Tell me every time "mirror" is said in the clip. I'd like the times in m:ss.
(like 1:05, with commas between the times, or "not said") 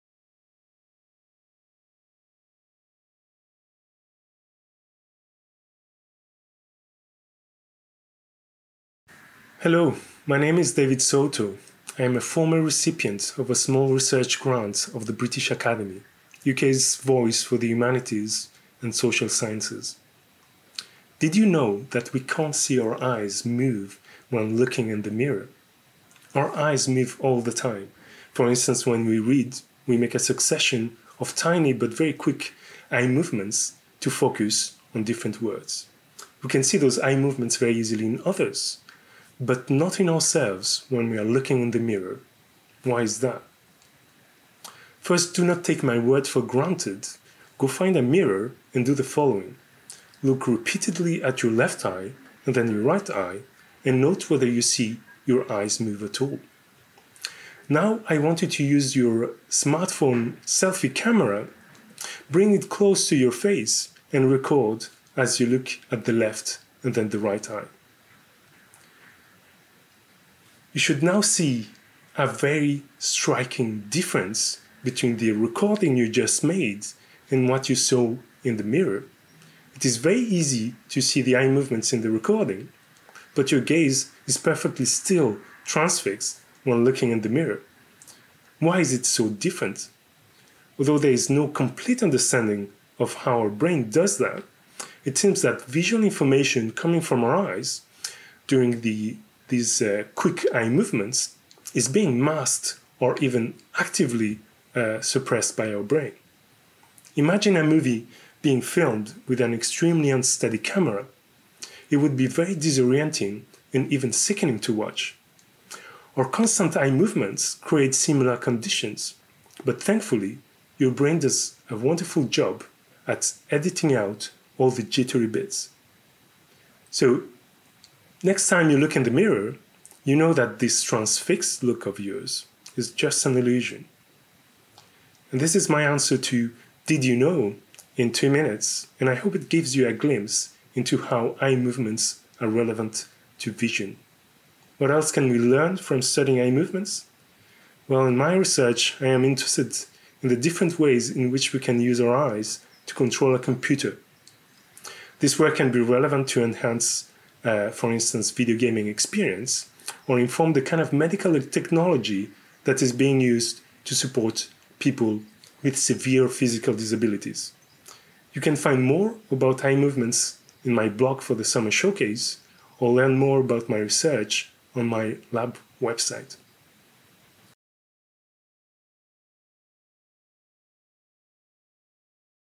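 0:25, 0:41, 0:48, 1:18, 1:27, 2:09.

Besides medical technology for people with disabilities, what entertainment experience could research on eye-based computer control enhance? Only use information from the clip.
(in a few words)
video gaming.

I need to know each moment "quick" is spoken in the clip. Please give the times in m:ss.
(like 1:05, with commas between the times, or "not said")
0:32, 1:40.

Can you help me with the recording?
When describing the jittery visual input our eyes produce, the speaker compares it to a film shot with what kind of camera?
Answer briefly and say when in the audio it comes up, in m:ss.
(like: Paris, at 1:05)
extremely unsteady camera, at 1:49.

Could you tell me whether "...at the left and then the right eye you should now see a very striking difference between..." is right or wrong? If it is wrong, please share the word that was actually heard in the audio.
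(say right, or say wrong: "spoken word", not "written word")
right.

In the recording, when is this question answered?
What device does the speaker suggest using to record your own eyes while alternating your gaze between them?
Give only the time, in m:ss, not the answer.
0:59.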